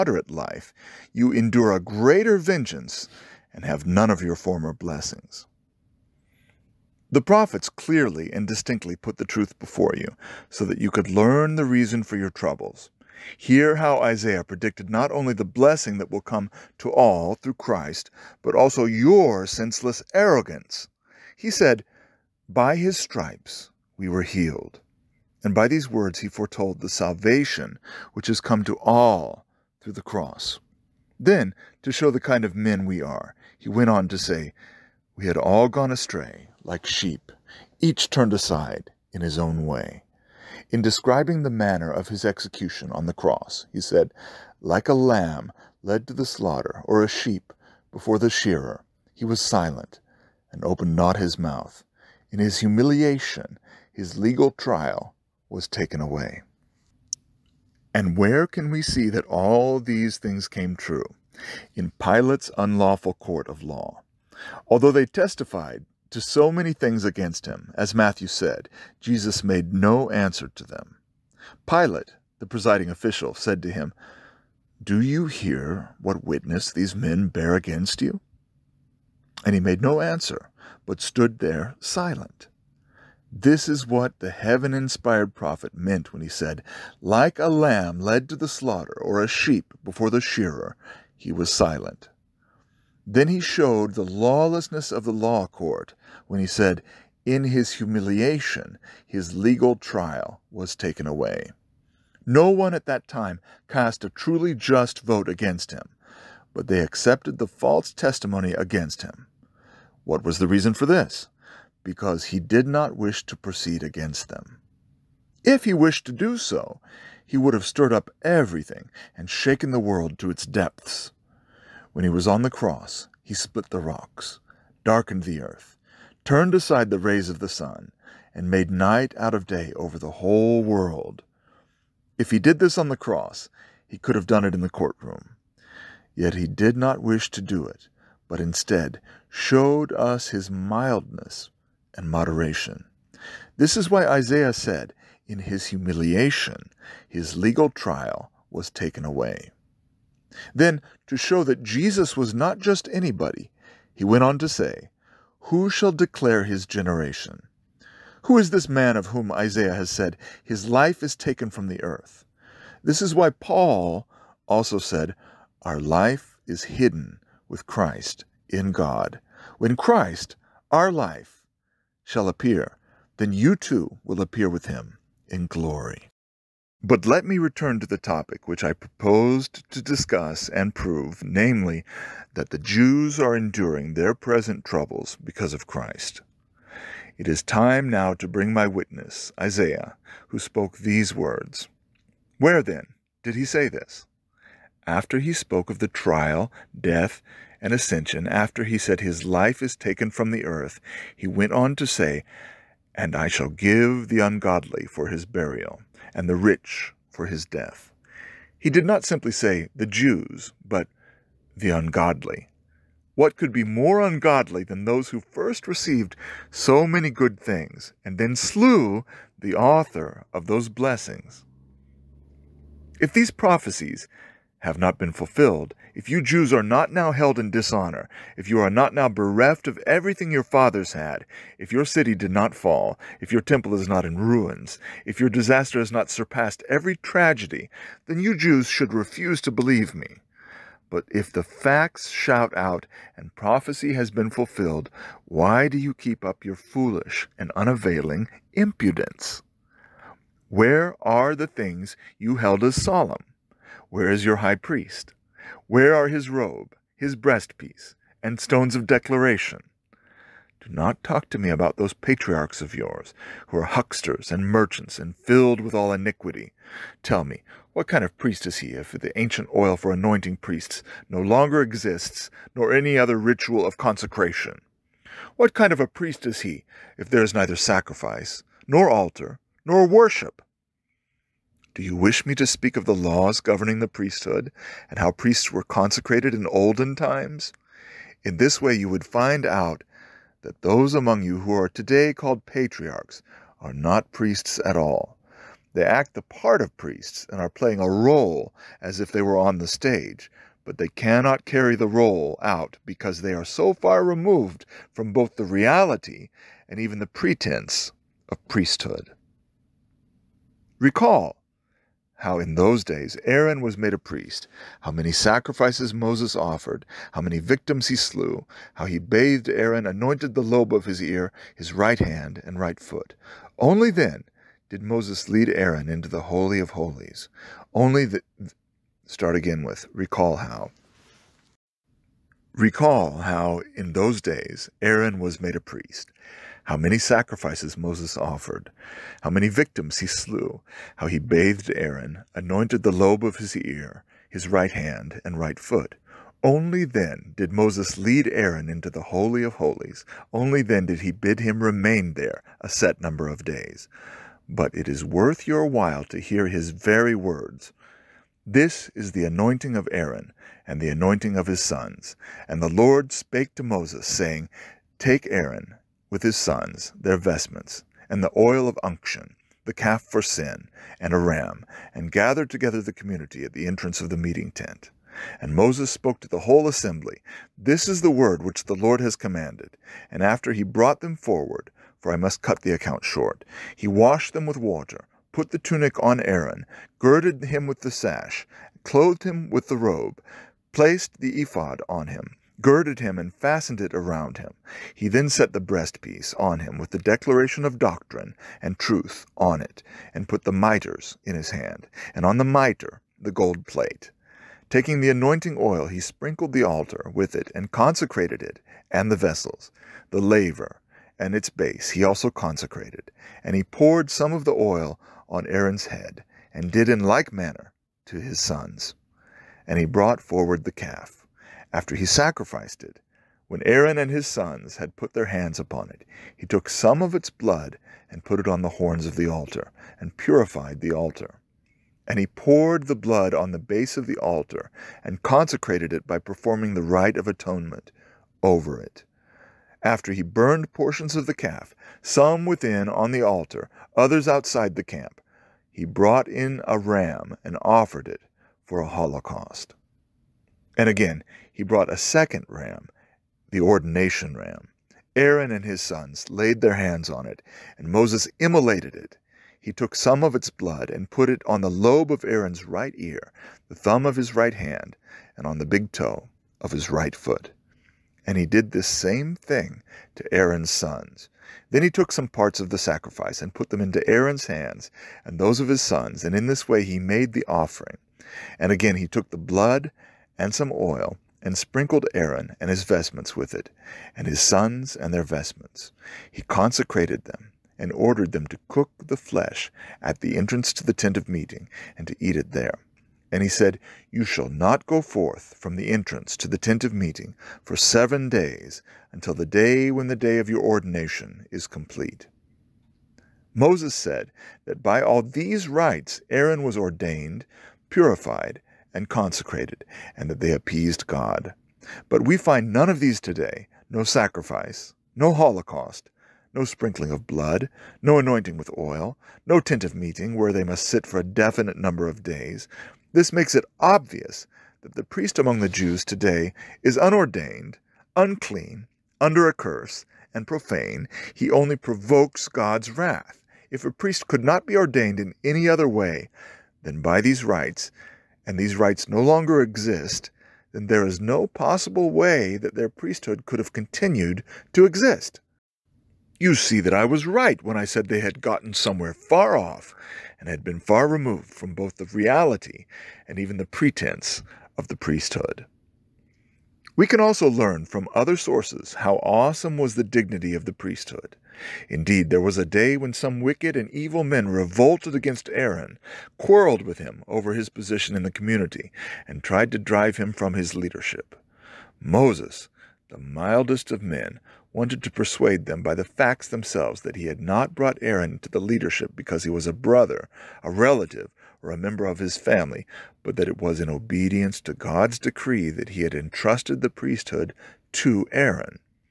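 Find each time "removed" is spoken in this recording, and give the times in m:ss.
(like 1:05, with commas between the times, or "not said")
5:04, 9:11.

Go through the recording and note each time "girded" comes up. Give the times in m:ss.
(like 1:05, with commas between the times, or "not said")
6:26, 6:32.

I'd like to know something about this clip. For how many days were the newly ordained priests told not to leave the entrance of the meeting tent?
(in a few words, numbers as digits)
7.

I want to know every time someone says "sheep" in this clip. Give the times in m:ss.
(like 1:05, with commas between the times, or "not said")
0:36, 0:47, 1:29.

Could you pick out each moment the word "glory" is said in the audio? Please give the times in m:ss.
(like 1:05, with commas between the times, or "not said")
2:55.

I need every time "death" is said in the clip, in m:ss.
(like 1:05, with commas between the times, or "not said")
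3:16, 3:27.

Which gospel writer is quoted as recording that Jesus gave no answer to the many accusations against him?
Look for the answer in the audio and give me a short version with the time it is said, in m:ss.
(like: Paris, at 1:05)
Matthew, at 1:07.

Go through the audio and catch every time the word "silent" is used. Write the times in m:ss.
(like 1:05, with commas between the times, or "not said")
0:49, 1:21, 1:31.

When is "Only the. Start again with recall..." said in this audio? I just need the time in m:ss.
5:27.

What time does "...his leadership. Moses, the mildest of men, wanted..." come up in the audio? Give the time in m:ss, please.
9:30.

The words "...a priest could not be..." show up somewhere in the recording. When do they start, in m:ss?
8:53.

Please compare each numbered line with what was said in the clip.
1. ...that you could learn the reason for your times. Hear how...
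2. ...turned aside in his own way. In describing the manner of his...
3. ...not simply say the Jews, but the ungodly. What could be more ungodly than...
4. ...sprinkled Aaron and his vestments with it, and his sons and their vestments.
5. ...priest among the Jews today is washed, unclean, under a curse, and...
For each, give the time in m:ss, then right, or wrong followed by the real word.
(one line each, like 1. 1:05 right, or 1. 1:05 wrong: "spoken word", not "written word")
1. 0:10 wrong: "troubles", not "times"
2. 0:38 right
3. 3:28 right
4. 8:01 right
5. 8:45 wrong: "unordained", not "washed".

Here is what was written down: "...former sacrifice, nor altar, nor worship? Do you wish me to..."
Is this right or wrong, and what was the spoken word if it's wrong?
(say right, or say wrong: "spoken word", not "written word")
wrong: "neither", not "former".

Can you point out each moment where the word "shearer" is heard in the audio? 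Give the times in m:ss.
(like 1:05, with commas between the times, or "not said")
0:48, 1:30.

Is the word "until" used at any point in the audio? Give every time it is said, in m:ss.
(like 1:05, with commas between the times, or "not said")
8:19.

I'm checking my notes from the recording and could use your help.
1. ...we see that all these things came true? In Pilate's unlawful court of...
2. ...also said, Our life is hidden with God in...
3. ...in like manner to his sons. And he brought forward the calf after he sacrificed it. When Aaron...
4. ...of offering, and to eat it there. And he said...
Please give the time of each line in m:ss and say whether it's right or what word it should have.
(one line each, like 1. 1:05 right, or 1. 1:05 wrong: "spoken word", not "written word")
1. 0:58 right
2. 2:44 wrong: "Christ", not "God"
3. 6:56 right
4. 8:11 wrong: "meeting", not "offering".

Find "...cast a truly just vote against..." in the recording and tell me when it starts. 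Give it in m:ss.
1:43.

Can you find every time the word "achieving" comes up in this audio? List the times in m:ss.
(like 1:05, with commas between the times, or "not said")
not said.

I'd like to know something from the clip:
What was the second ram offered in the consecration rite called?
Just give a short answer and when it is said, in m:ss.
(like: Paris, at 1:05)
Ordination ram, at 7:33.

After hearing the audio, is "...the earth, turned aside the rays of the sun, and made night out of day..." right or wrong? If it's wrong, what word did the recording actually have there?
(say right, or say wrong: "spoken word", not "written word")
right.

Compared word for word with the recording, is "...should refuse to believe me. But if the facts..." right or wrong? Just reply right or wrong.
right.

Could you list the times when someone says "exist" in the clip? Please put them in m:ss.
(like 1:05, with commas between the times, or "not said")
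4:31, 8:59, 9:04.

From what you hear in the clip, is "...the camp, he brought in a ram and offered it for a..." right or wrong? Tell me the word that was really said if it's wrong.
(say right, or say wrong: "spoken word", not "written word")
right.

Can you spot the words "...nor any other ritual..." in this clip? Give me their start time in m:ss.
4:32.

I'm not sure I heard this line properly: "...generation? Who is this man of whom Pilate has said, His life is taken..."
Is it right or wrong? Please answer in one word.
wrong.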